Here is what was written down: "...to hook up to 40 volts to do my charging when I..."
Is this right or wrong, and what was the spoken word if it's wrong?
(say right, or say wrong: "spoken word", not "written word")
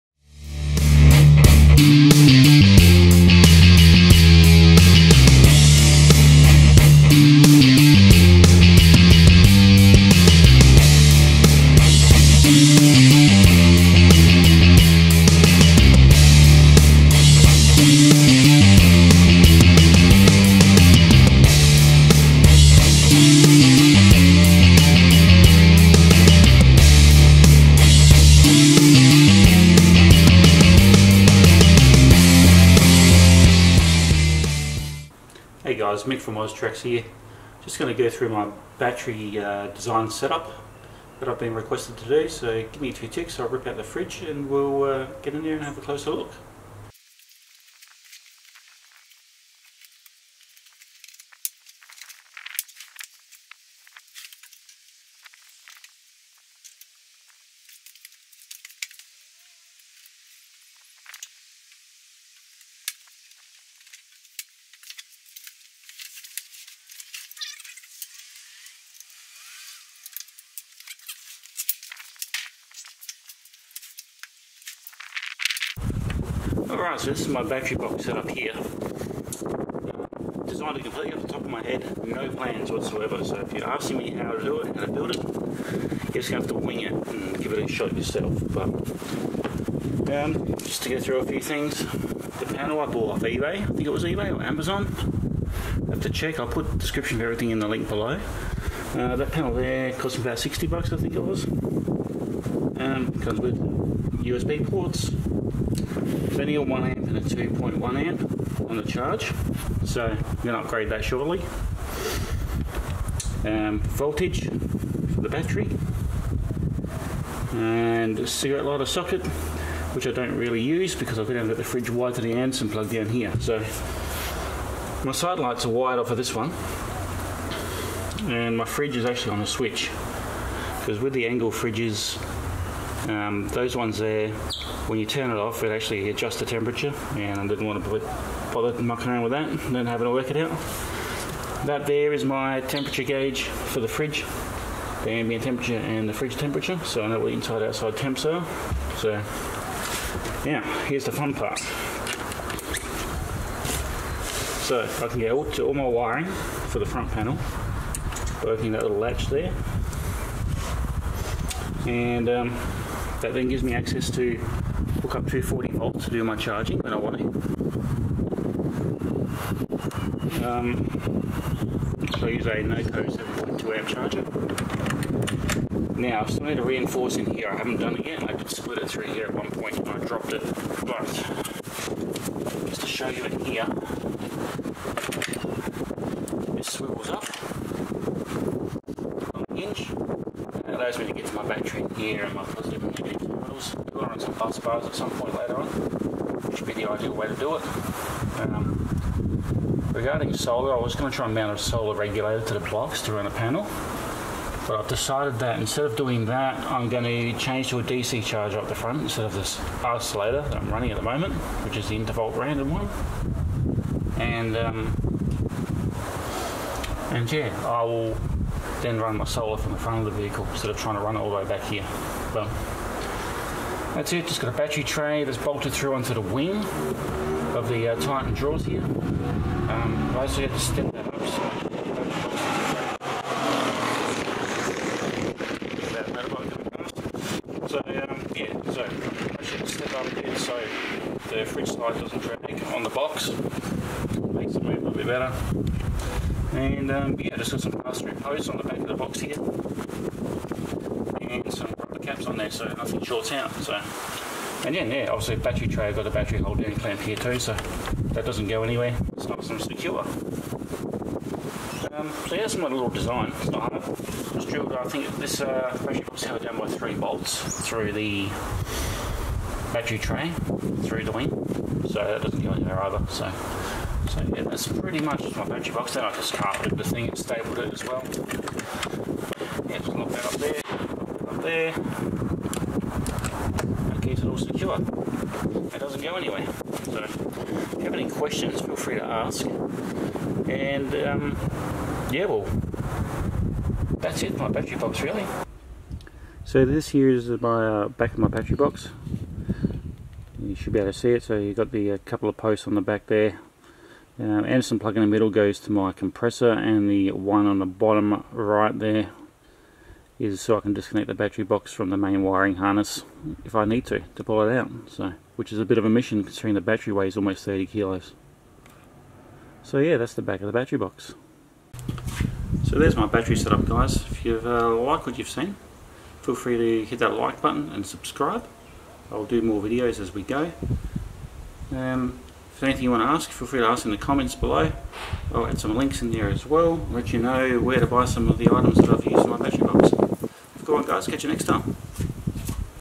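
right.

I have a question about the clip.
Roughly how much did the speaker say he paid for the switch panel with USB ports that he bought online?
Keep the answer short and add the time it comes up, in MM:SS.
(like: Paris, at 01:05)
60 bucks, at 01:40.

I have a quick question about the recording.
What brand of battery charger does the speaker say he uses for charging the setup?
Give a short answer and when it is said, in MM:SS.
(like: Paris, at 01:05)
NoCo, at 02:52.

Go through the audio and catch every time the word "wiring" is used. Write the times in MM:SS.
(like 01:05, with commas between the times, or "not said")
02:35, 05:12.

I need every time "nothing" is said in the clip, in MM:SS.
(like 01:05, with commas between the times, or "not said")
04:12.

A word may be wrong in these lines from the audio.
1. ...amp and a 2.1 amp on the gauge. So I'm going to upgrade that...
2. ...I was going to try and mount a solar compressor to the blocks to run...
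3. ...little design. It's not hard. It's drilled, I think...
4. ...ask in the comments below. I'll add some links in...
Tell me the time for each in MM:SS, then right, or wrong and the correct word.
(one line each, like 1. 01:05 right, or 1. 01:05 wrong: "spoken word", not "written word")
1. 01:46 wrong: "charge", not "gauge"
2. 03:20 wrong: "regulator", not "compressor"
3. 04:22 right
4. 05:33 right.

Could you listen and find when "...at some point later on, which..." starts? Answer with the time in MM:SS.
03:14.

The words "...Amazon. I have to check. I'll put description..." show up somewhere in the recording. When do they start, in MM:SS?
01:34.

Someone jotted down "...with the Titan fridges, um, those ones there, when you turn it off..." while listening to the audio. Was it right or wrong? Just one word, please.
wrong.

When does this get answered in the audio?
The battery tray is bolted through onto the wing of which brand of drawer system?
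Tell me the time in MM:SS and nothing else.
03:48.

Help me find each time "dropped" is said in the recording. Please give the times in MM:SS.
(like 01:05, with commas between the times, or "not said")
03:00.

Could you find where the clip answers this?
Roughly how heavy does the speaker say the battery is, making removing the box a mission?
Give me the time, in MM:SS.
05:17.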